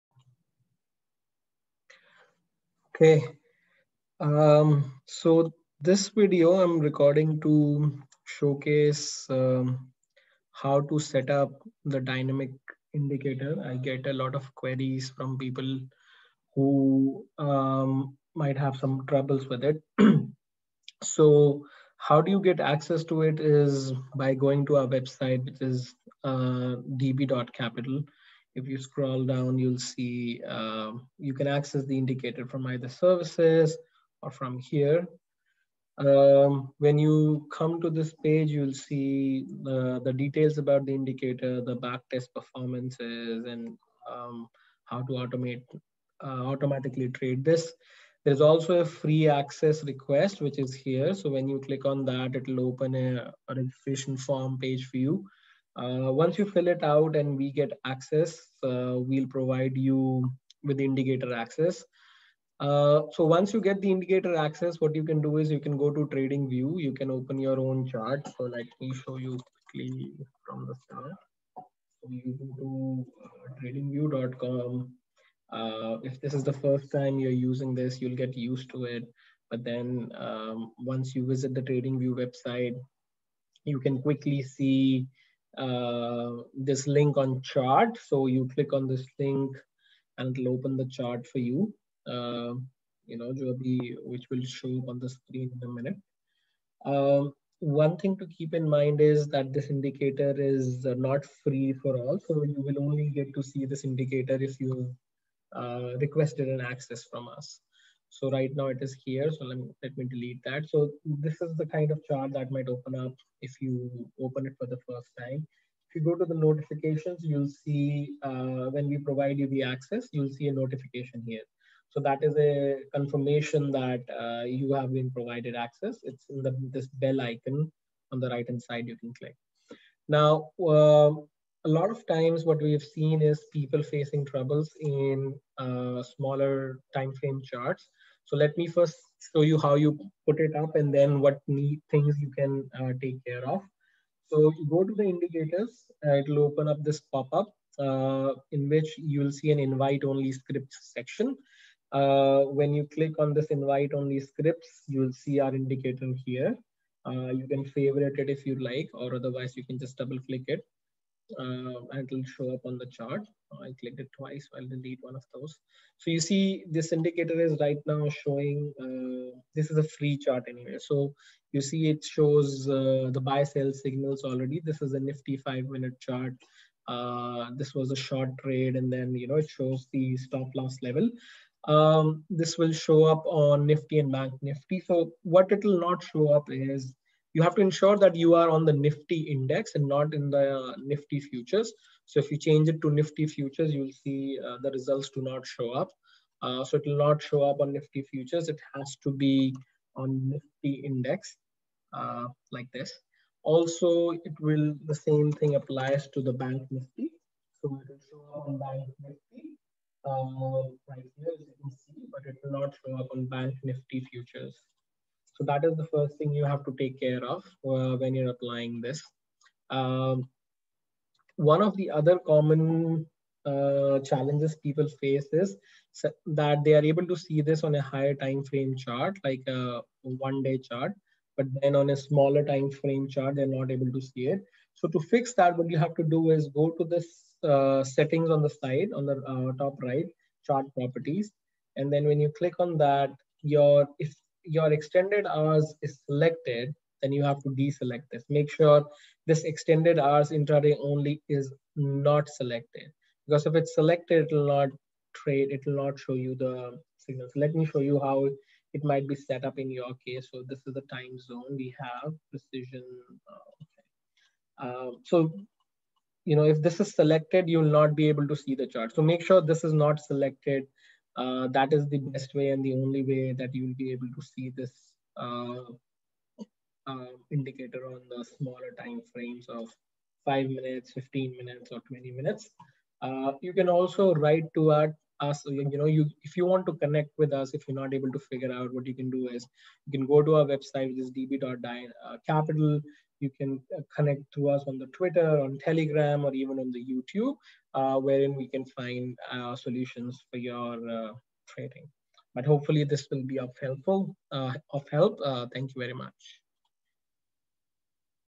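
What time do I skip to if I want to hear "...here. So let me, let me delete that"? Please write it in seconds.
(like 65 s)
109 s.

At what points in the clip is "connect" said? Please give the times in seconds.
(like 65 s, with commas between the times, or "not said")
286 s, 293 s.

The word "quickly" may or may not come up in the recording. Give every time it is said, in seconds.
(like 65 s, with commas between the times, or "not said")
69 s, 84 s.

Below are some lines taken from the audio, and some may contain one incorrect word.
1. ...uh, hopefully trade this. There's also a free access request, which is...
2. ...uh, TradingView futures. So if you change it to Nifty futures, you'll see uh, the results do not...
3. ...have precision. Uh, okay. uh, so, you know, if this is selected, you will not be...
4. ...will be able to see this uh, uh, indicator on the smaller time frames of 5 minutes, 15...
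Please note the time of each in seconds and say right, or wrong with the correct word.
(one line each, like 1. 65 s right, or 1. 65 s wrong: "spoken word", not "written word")
1. 46 s wrong: "automatically", not "hopefully"
2. 190 s wrong: "Nifty", not "TradingView"
3. 261 s right
4. 273 s right.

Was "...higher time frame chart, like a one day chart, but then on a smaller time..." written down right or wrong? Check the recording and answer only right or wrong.
right.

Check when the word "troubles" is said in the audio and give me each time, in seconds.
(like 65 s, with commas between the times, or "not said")
19 s, 134 s.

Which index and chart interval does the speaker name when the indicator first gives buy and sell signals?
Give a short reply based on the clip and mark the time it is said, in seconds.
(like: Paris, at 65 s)
Nifty 5 minute, at 174 s.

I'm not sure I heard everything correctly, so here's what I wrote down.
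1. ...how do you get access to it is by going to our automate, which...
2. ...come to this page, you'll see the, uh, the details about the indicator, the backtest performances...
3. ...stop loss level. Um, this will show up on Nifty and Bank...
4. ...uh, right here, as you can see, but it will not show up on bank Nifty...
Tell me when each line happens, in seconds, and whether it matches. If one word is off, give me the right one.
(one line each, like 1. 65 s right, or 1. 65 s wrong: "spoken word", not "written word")
1. 21 s wrong: "website", not "automate"
2. 37 s right
3. 180 s right
4. 210 s right.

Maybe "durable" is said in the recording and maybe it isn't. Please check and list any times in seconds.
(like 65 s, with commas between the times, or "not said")
not said.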